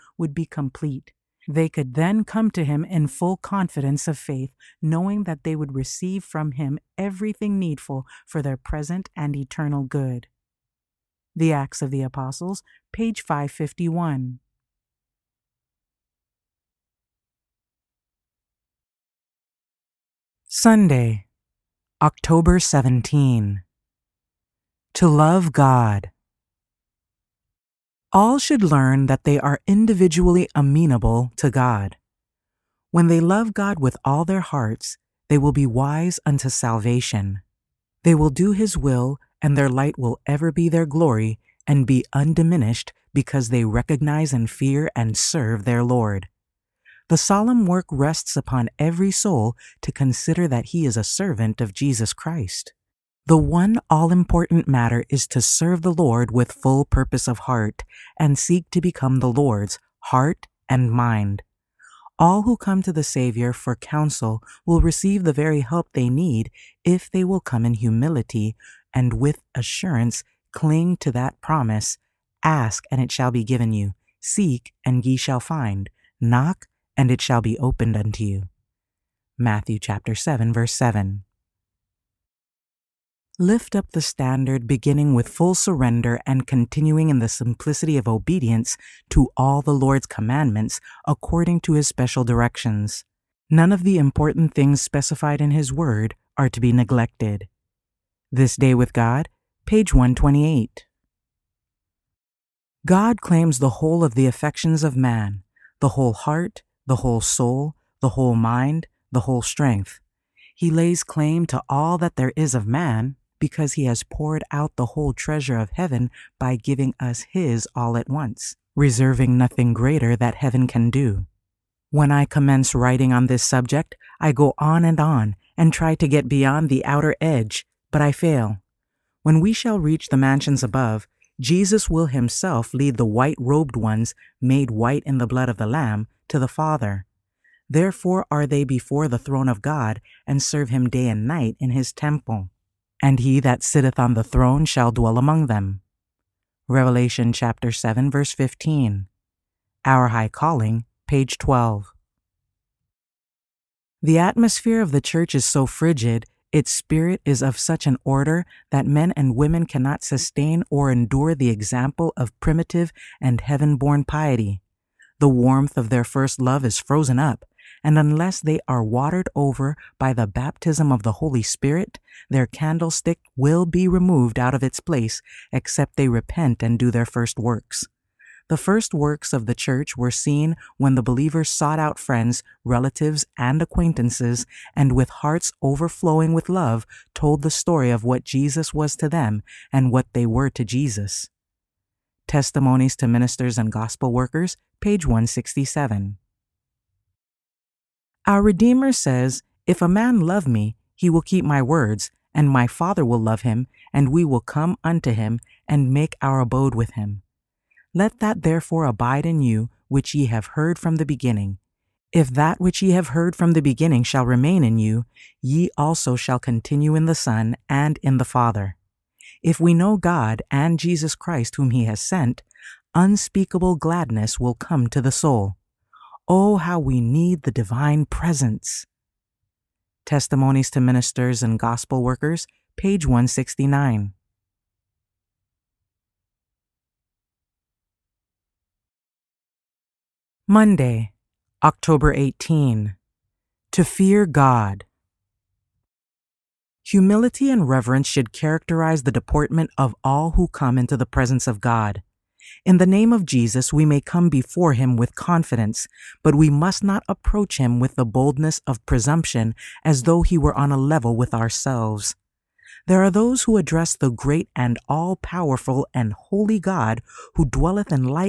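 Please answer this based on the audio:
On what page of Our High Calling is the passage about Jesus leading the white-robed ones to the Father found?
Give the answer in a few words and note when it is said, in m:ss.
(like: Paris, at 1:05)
12, at 2:31.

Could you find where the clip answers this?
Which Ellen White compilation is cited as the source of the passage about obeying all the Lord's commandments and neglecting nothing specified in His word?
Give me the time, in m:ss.
1:38.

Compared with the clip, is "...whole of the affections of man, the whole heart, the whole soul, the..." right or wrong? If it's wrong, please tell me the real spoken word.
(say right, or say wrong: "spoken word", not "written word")
right.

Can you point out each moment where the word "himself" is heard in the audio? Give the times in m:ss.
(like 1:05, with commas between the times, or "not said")
2:12.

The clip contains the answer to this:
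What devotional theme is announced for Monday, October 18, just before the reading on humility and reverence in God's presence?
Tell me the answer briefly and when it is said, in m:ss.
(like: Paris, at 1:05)
To fear God, at 4:03.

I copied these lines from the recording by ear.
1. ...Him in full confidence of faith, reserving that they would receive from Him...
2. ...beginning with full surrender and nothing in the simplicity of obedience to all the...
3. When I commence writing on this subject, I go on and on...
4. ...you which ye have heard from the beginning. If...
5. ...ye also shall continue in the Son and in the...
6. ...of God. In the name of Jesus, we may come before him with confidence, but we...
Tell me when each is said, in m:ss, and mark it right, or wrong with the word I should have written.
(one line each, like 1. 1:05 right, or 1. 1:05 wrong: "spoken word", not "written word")
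1. 0:02 wrong: "knowing", not "reserving"
2. 1:24 wrong: "continuing", not "nothing"
3. 2:01 right
4. 3:29 right
5. 3:35 right
6. 4:11 right.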